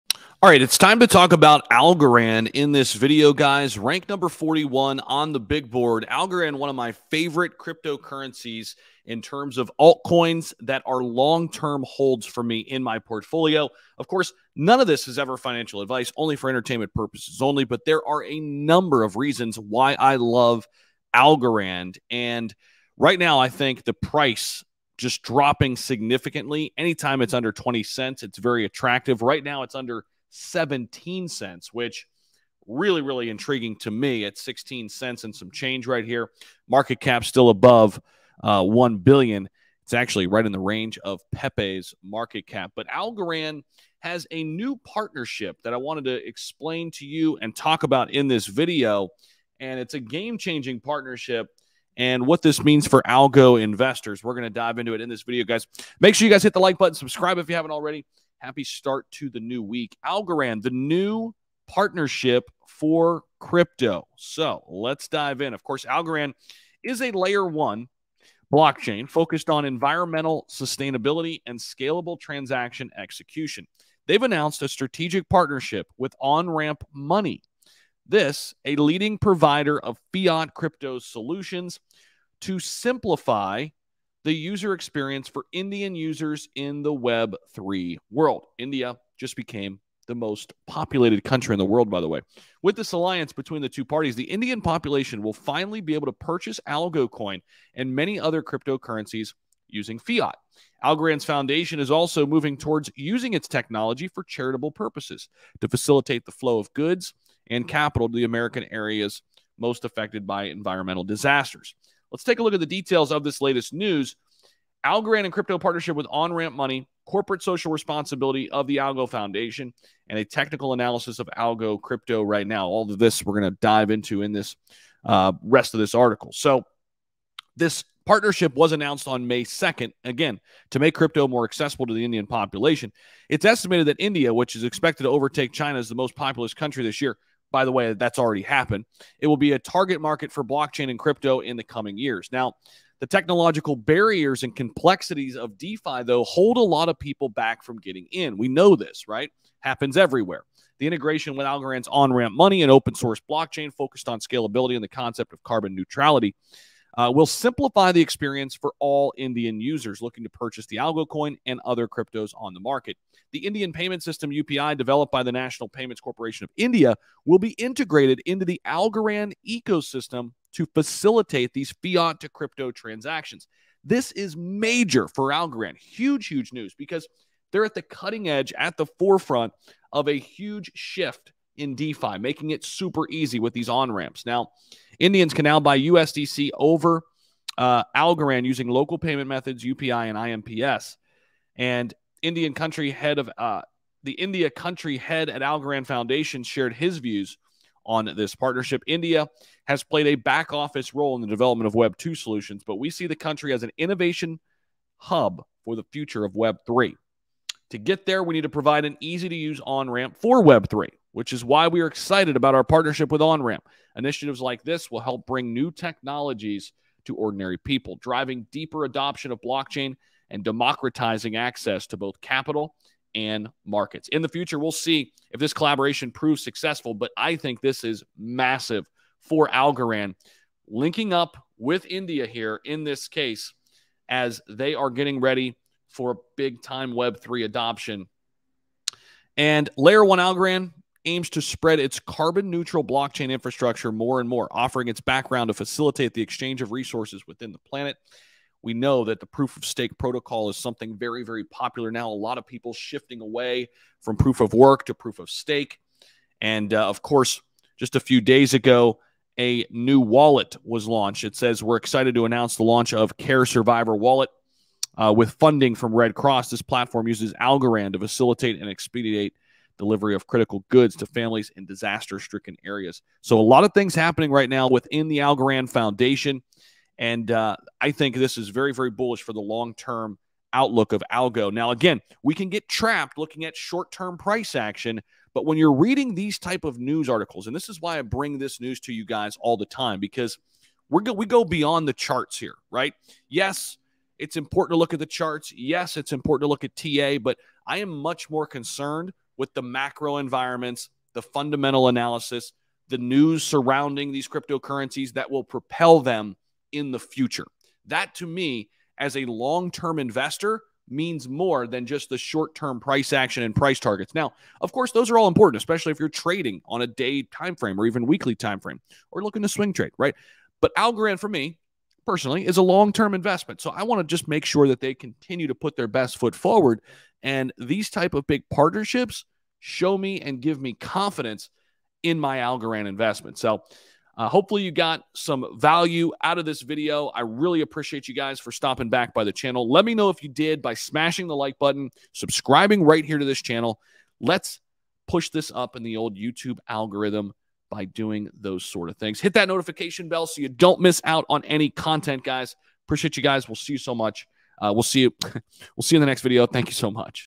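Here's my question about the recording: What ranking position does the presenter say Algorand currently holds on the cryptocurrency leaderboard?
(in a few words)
41.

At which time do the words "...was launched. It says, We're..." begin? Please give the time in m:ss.
4:20.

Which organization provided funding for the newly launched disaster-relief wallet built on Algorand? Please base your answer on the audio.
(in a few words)
Red Cross.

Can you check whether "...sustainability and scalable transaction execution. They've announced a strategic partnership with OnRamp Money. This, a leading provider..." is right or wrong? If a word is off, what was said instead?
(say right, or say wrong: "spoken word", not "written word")
right.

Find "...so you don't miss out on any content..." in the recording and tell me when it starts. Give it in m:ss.
5:50.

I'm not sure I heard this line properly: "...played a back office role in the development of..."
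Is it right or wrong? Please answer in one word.
right.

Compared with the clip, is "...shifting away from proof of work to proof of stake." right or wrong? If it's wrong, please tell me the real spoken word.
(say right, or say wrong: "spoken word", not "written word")
right.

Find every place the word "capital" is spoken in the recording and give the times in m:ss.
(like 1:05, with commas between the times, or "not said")
1:47, 3:42.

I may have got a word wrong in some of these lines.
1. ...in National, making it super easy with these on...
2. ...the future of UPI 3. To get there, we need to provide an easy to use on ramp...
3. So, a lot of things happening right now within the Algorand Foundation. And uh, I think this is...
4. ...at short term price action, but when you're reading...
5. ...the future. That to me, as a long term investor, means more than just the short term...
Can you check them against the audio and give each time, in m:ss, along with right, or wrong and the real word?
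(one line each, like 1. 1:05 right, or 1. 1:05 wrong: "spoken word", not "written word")
1. 3:01 wrong: "DeFi", not "National"
2. 3:25 wrong: "Web", not "UPI"
3. 4:33 right
4. 4:43 right
5. 5:06 right.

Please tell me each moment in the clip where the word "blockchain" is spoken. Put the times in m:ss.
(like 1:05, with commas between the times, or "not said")
1:08, 2:20, 2:33, 3:39, 4:02.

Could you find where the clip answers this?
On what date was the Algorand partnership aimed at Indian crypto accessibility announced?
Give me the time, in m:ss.
2:09.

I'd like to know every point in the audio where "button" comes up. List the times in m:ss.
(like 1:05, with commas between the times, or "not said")
0:56, 5:41.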